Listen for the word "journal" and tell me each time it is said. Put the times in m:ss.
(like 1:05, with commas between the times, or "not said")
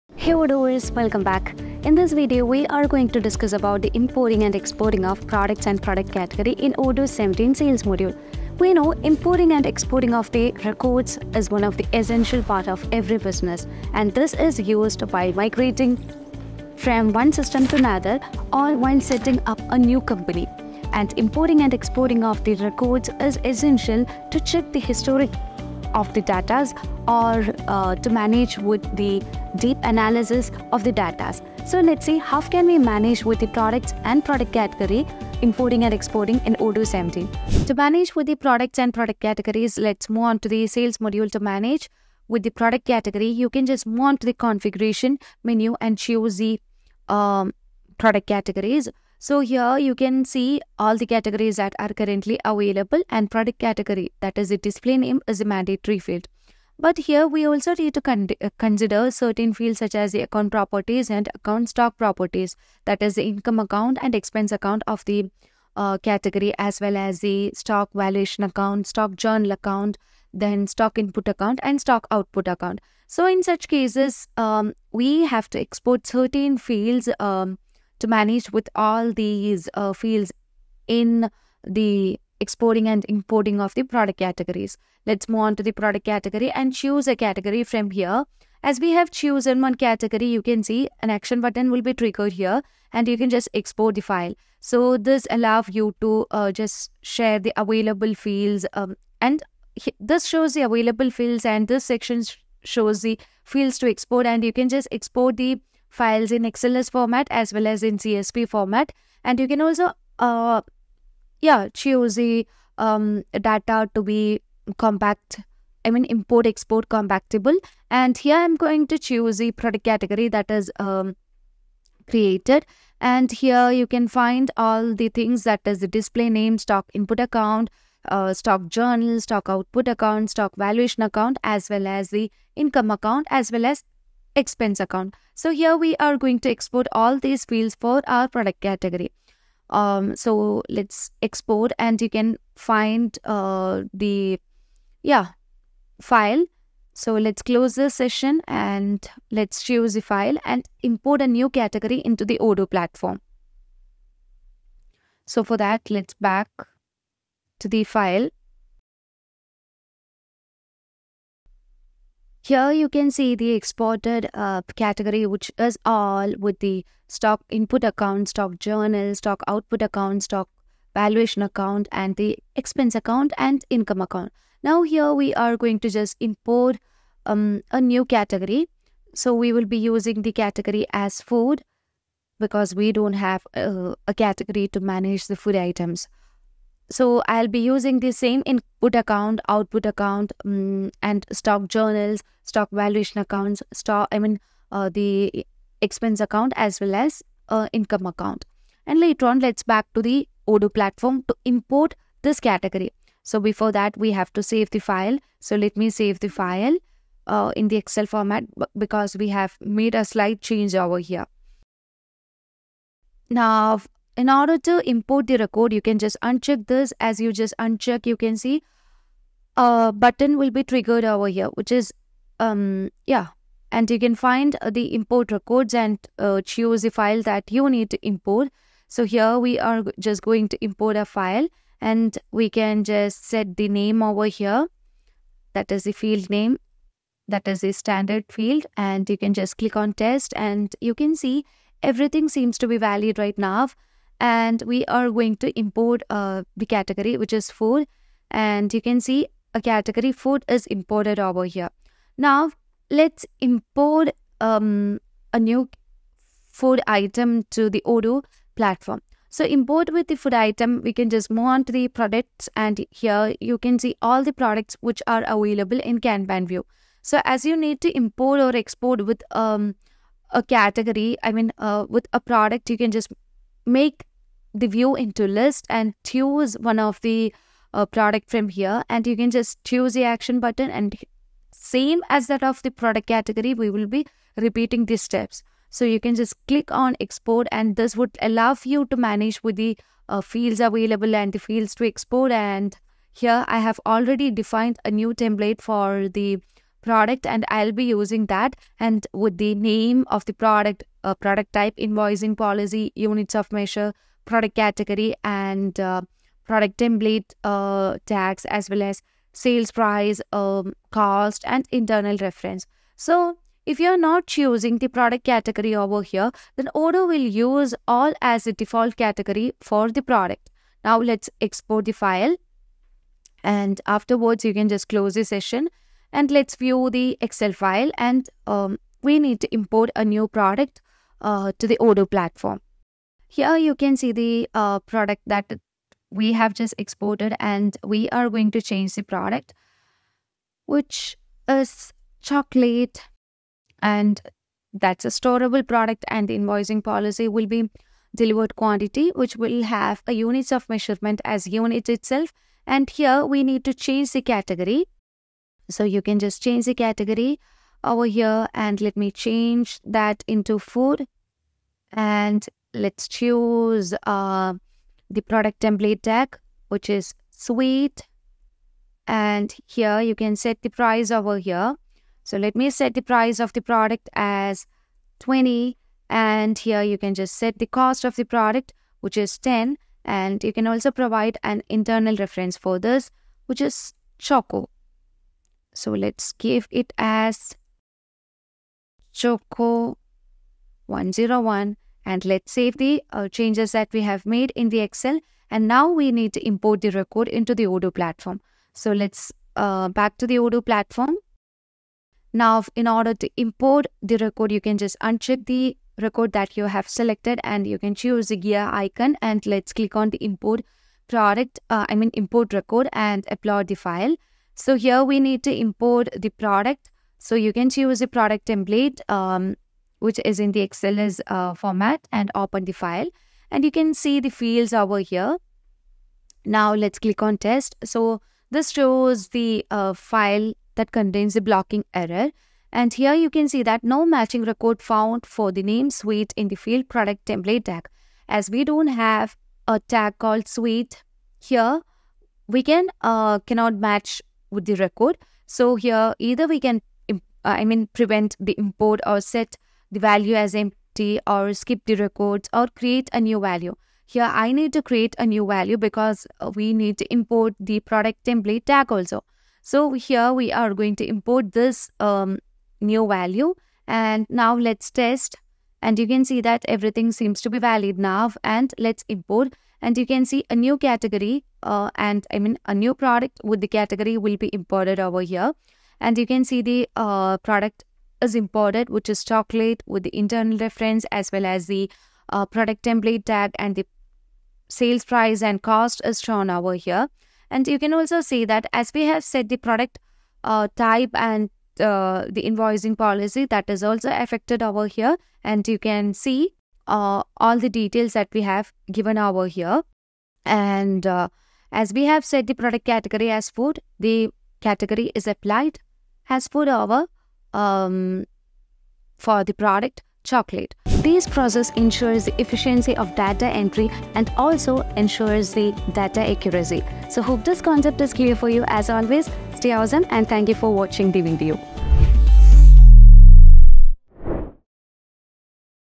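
1:09, 2:08, 2:48, 3:11.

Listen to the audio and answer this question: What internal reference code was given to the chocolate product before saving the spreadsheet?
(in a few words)
Choco 101.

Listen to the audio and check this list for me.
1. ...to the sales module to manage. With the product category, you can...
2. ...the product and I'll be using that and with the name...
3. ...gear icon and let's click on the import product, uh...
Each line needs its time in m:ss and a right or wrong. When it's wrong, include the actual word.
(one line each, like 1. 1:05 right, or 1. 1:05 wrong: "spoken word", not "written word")
1. 0:40 right
2. 4:56 right
3. 6:48 right.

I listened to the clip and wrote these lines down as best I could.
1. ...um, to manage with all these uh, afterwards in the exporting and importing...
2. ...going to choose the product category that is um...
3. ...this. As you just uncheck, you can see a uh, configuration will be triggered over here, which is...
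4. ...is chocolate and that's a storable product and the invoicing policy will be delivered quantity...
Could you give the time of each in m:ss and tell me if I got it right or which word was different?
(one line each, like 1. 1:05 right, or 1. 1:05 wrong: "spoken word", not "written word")
1. 1:17 wrong: "fields", not "afterwards"
2. 1:58 right
3. 3:36 wrong: "button", not "configuration"
4. 5:41 right.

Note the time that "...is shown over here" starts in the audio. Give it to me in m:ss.
8:06.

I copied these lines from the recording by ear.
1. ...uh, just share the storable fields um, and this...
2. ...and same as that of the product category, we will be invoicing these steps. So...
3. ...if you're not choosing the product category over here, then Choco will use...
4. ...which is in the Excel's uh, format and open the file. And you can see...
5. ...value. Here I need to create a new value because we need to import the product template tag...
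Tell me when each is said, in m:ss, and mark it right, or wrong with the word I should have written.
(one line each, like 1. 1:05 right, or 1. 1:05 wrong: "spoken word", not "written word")
1. 1:36 wrong: "available", not "storable"
2. 4:40 wrong: "repeating", not "invoicing"
3. 5:13 wrong: "Odoo", not "Choco"
4. 7:00 right
5. 7:33 right.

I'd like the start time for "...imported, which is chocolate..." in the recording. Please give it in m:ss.
7:58.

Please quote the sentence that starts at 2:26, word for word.
So let's close the session and let's choose the file and import a new category into the Odoo platform.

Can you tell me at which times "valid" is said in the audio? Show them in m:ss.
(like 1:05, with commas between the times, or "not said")
4:02, 7:47.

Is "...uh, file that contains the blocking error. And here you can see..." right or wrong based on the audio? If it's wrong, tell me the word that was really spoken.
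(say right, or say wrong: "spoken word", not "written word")
right.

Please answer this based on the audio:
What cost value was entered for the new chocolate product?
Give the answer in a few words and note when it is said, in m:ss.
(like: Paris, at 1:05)
10, at 6:19.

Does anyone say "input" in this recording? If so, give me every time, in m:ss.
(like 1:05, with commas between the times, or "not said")
1:10, 2:06, 2:47, 3:08.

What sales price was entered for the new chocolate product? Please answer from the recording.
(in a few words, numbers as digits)
20.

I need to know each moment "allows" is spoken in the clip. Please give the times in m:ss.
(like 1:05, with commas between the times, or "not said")
1:35, 4:48.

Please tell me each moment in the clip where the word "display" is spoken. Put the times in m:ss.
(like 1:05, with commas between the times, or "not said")
0:54, 2:05.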